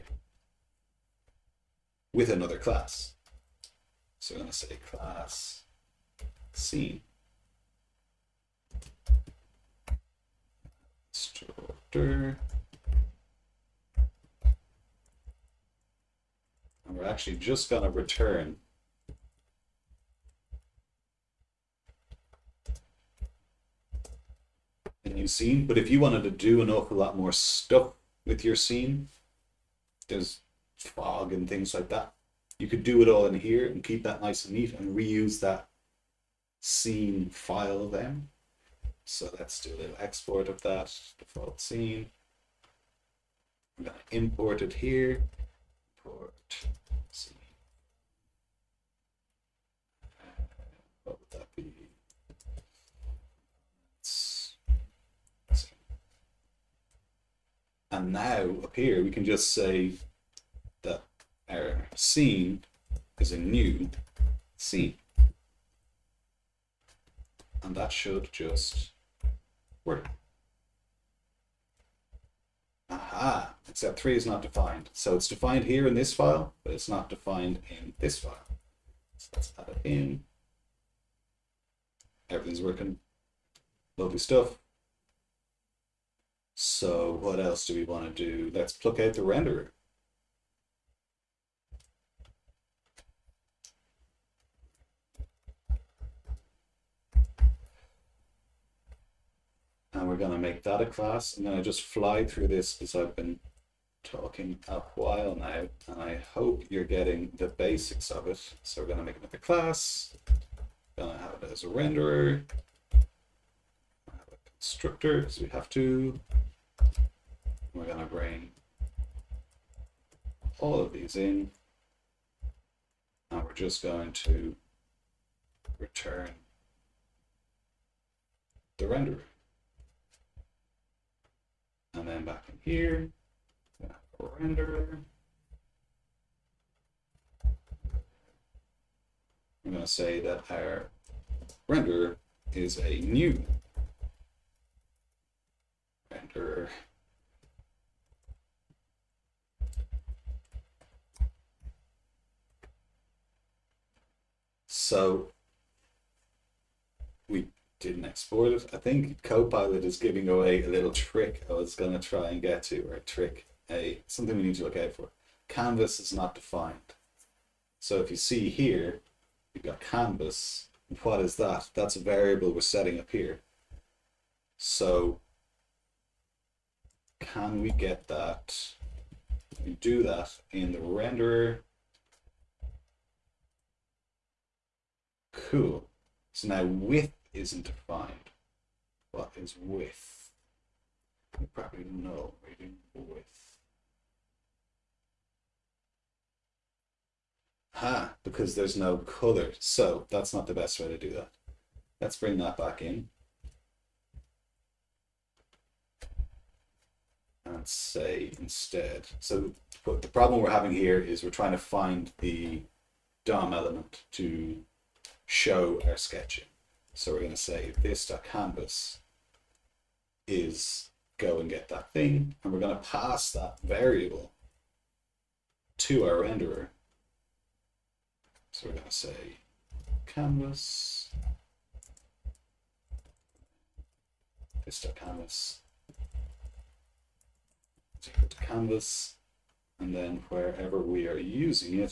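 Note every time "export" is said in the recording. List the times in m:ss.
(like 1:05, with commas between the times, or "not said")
0:39, 2:38.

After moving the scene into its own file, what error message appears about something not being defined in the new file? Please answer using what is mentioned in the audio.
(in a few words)
3 is not defined.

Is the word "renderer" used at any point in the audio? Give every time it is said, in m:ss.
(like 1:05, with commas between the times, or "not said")
1:29, 1:51, 2:08, 2:14, 2:21, 3:00, 3:46.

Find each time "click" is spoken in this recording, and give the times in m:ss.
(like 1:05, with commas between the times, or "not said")
not said.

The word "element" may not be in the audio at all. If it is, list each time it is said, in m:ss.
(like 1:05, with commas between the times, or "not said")
3:33.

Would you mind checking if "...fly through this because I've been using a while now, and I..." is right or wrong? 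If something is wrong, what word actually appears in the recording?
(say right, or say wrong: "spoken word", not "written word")
wrong: "talking", not "using".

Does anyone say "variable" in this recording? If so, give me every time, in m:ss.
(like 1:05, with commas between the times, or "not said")
2:51, 3:43.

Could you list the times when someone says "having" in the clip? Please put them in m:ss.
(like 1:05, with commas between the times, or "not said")
3:30.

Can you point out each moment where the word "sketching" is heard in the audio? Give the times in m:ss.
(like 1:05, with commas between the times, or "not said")
3:35.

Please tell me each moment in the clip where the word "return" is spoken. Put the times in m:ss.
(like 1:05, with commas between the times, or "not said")
0:17, 2:05.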